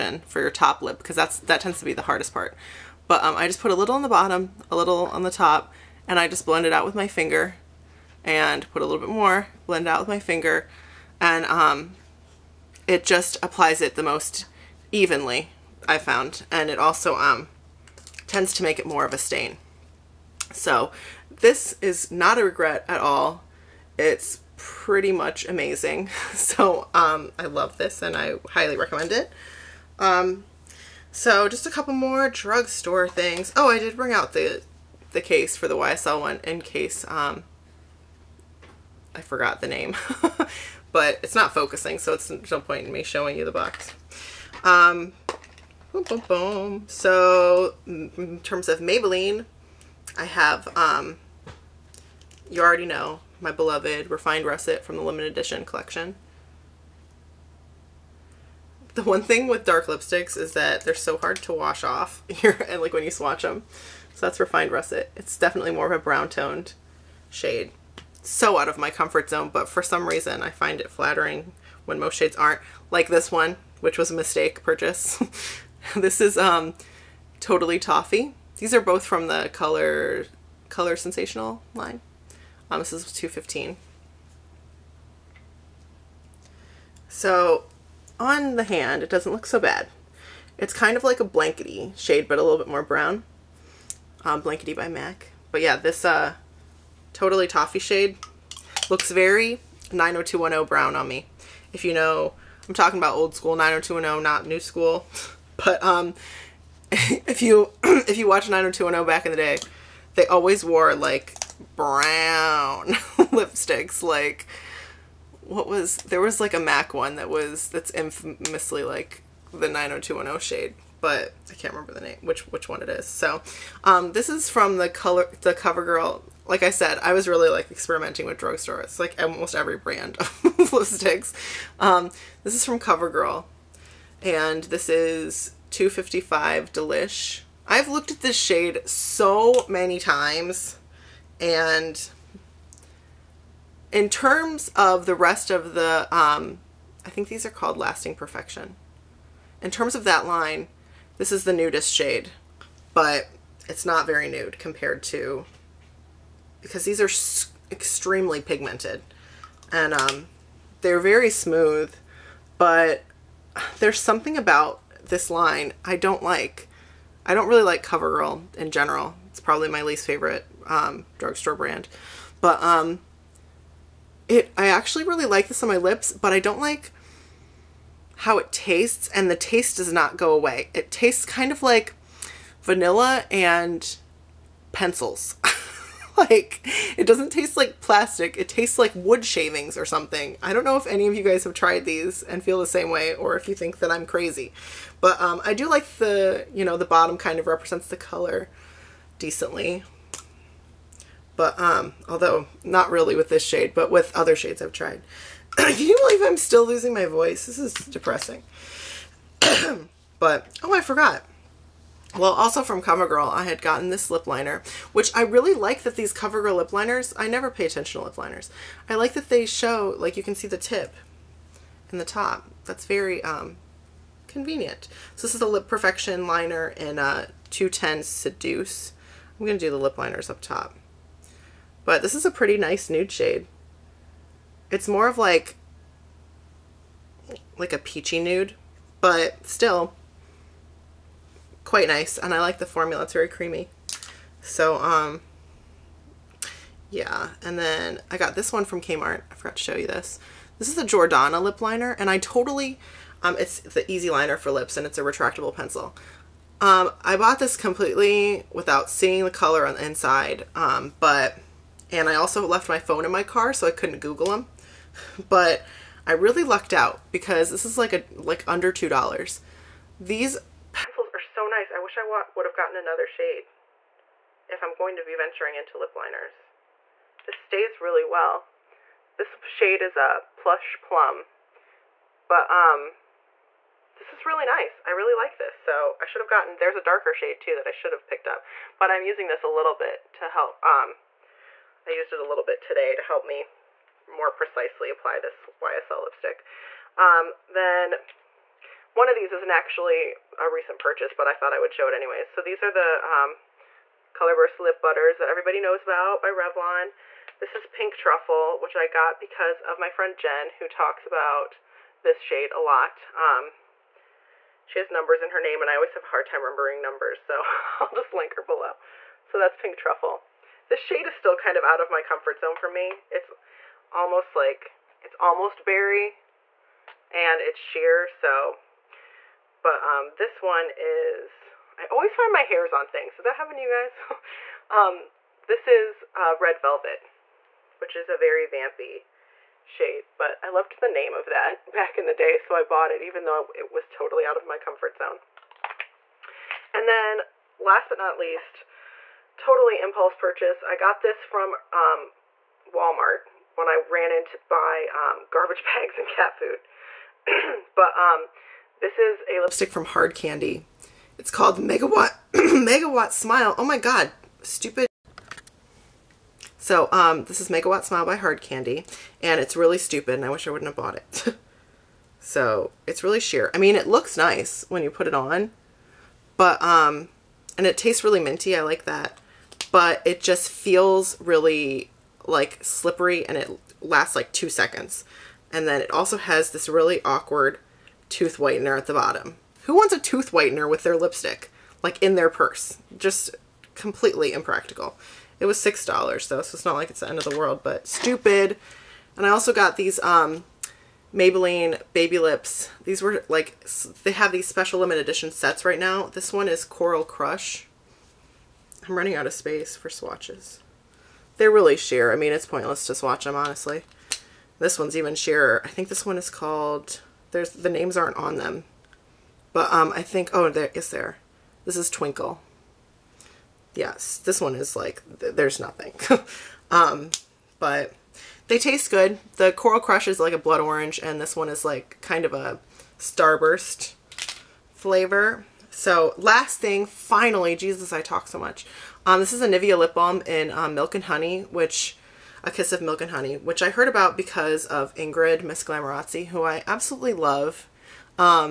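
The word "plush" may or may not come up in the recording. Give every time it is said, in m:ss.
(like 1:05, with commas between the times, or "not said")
4:40.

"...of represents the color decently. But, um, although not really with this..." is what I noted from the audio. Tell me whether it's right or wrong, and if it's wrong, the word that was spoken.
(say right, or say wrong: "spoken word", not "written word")
right.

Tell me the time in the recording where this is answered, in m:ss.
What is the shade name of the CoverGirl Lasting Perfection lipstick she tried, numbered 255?
2:16.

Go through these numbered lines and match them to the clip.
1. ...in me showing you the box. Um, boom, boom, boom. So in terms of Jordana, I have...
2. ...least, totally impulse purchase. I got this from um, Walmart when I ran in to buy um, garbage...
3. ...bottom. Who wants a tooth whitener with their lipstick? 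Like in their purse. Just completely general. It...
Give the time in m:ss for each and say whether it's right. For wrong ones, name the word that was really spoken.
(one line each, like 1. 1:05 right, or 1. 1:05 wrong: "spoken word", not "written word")
1. 0:42 wrong: "Maybelline", not "Jordana"
2. 5:48 right
3. 6:28 wrong: "impractical", not "general".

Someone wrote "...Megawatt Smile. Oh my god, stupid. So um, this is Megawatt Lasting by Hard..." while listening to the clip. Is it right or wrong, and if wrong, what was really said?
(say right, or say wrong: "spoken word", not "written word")
wrong: "Smile", not "Lasting".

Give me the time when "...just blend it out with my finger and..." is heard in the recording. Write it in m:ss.
0:06.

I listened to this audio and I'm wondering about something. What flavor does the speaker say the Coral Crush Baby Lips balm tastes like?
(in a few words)
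blood orange.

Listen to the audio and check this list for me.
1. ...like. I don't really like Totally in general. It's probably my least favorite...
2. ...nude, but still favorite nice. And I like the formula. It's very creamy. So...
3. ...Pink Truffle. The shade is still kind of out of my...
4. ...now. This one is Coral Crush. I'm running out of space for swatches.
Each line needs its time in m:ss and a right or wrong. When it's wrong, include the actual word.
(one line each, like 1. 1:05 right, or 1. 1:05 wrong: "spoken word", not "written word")
1. 2:46 wrong: "CoverGirl", not "Totally"
2. 3:58 wrong: "quite", not "favorite"
3. 5:19 right
4. 6:45 right.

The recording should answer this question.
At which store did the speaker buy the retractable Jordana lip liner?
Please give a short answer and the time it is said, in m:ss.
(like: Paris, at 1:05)
Kmart, at 4:08.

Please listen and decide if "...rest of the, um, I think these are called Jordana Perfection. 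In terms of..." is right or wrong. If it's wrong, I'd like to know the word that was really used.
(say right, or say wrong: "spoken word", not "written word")
wrong: "Lasting", not "Jordana".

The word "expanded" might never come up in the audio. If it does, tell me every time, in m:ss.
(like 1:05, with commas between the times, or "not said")
not said.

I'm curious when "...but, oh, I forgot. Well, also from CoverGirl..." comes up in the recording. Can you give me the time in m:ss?
3:30.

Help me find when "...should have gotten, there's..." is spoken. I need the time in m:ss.
4:46.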